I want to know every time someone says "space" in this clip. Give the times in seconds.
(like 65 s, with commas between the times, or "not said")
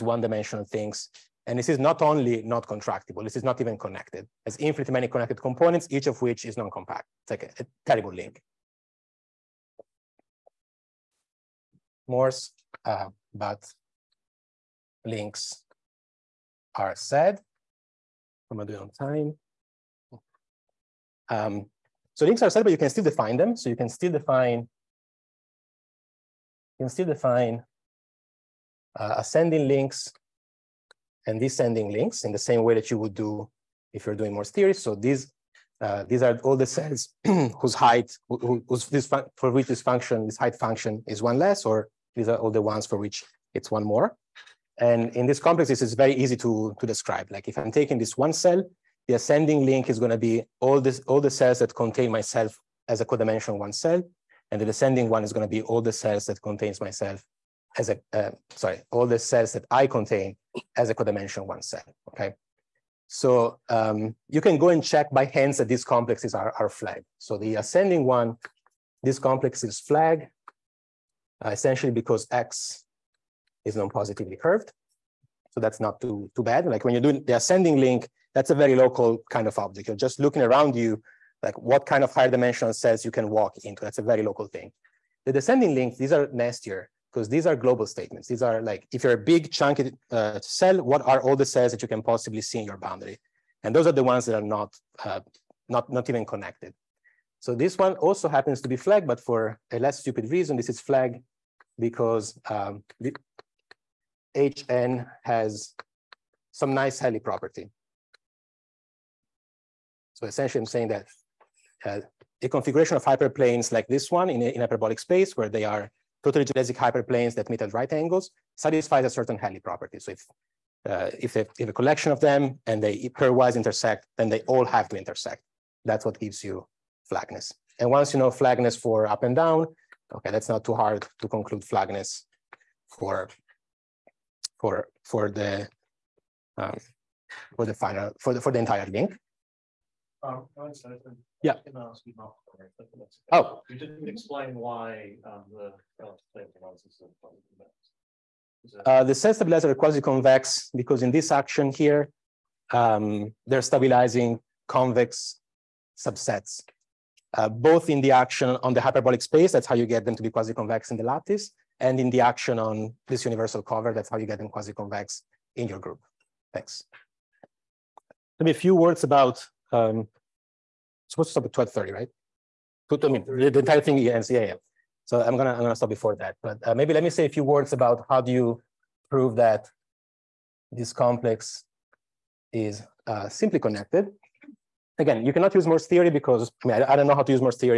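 114 s, 159 s.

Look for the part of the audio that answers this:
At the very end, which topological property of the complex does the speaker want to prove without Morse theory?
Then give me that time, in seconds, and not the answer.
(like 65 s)
183 s.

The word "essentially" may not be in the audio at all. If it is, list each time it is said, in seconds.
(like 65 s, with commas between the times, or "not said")
71 s, 110 s.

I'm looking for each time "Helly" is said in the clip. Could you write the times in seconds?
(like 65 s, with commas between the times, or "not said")
106 s, 119 s.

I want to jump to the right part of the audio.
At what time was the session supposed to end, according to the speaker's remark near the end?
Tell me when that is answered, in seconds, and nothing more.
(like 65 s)
171 s.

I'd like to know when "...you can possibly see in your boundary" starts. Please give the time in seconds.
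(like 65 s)
91 s.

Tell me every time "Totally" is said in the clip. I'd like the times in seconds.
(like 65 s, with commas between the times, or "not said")
116 s.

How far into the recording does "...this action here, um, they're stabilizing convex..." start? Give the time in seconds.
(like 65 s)
151 s.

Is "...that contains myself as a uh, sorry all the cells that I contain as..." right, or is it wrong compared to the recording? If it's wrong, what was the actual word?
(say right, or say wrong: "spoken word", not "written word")
right.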